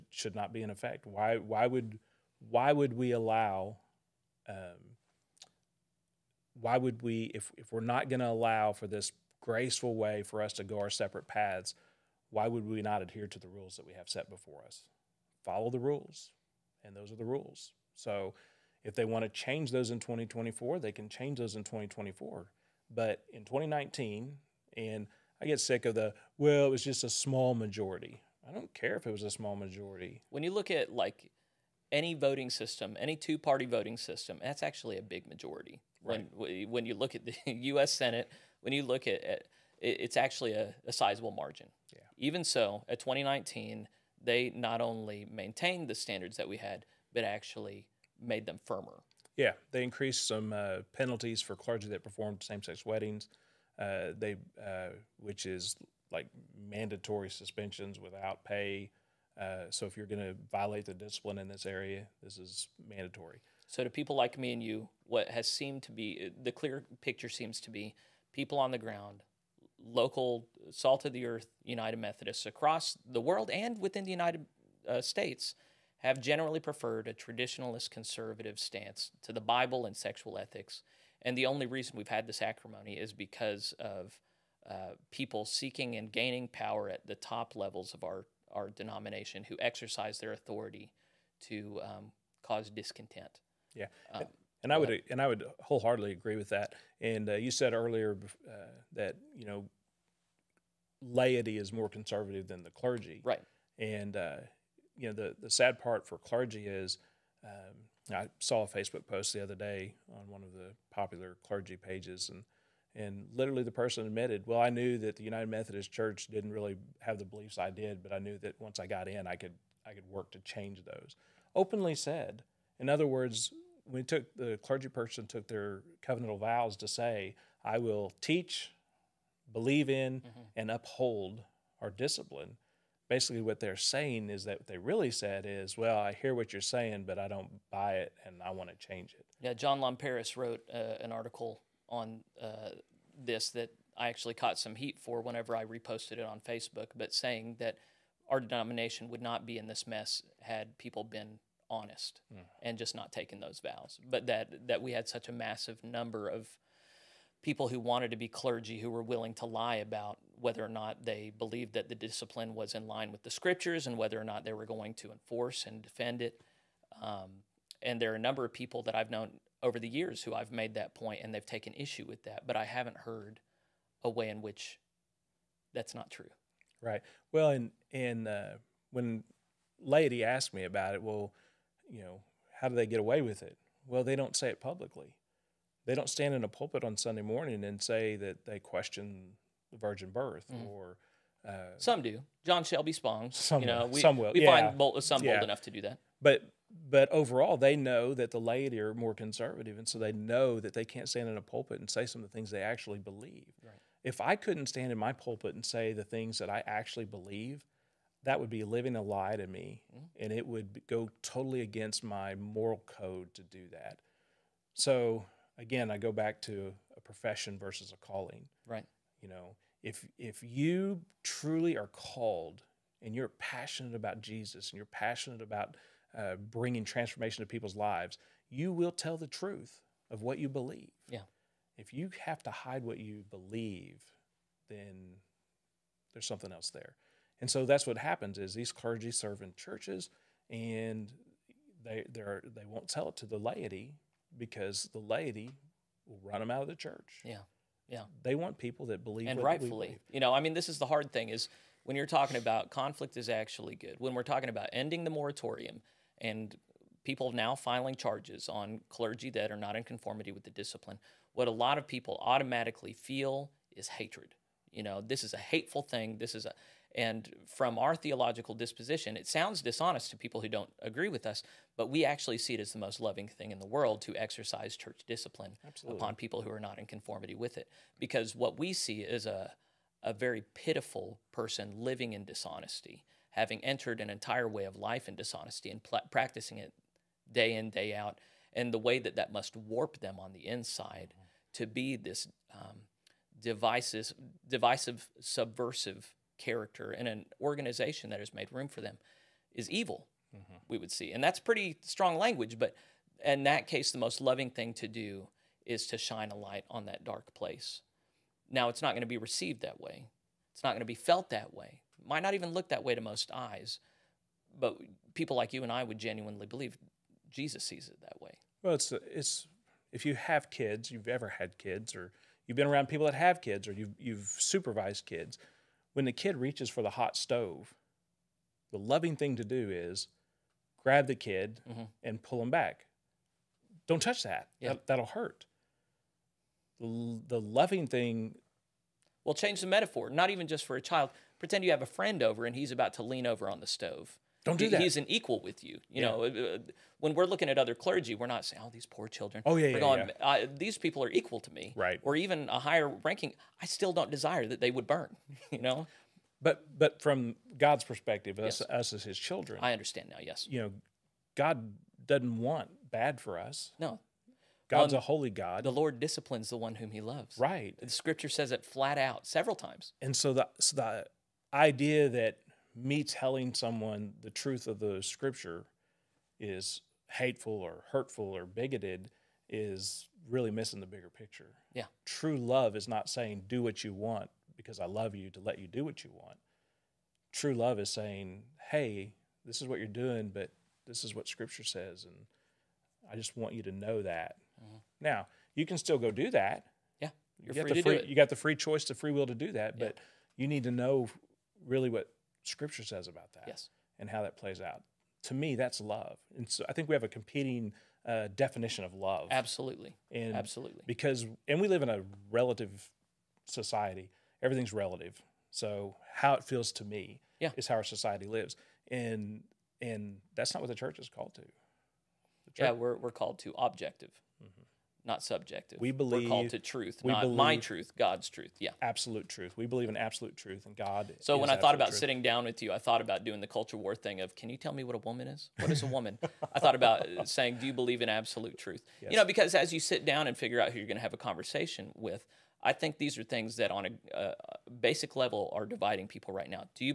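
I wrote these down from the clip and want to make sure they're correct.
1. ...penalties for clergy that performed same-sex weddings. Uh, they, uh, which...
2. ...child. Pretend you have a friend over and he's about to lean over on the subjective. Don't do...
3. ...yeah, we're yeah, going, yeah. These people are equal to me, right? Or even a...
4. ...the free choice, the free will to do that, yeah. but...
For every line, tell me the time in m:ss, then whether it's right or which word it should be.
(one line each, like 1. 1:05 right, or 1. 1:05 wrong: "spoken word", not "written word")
1. 0:50 right
2. 5:40 wrong: "stove", not "subjective"
3. 5:49 right
4. 6:38 right.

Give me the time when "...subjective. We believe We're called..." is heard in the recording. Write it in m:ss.
7:05.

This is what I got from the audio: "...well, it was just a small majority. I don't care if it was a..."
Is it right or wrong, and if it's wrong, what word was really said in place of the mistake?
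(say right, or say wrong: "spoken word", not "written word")
right.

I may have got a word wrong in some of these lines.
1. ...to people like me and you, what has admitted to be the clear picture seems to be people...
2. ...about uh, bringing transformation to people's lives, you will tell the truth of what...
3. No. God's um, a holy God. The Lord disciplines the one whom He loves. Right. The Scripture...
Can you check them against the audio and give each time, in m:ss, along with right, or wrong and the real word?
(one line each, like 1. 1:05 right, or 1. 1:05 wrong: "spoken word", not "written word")
1. 1:03 wrong: "seemed", not "admitted"
2. 3:45 right
3. 6:03 right.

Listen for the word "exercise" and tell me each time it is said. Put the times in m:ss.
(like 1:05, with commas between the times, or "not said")
1:29, 4:34.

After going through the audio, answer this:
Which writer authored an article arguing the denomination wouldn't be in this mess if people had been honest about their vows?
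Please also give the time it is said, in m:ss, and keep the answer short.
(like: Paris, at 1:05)
John Lomperis, at 2:19.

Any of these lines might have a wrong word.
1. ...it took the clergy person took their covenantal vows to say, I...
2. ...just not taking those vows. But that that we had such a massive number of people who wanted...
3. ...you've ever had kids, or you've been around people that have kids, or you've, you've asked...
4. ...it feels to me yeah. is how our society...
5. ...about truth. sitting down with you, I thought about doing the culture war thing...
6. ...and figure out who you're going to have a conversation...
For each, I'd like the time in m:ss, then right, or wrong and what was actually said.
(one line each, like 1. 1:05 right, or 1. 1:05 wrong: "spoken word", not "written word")
1. 2:04 right
2. 2:32 right
3. 5:20 wrong: "supervised", not "asked"
4. 6:56 right
5. 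7:11 right
6. 7:20 right.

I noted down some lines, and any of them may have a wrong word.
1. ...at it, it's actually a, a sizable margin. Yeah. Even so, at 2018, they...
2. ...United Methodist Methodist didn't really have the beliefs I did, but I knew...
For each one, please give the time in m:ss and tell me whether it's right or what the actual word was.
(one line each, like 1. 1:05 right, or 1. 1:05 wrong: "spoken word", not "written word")
1. 0:39 wrong: "2019", not "2018"
2. 1:55 wrong: "Church", not "Methodist".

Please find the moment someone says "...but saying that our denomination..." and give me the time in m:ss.
2:26.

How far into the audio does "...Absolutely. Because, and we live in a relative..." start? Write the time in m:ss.
6:50.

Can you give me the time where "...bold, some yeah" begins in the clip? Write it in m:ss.
3:14.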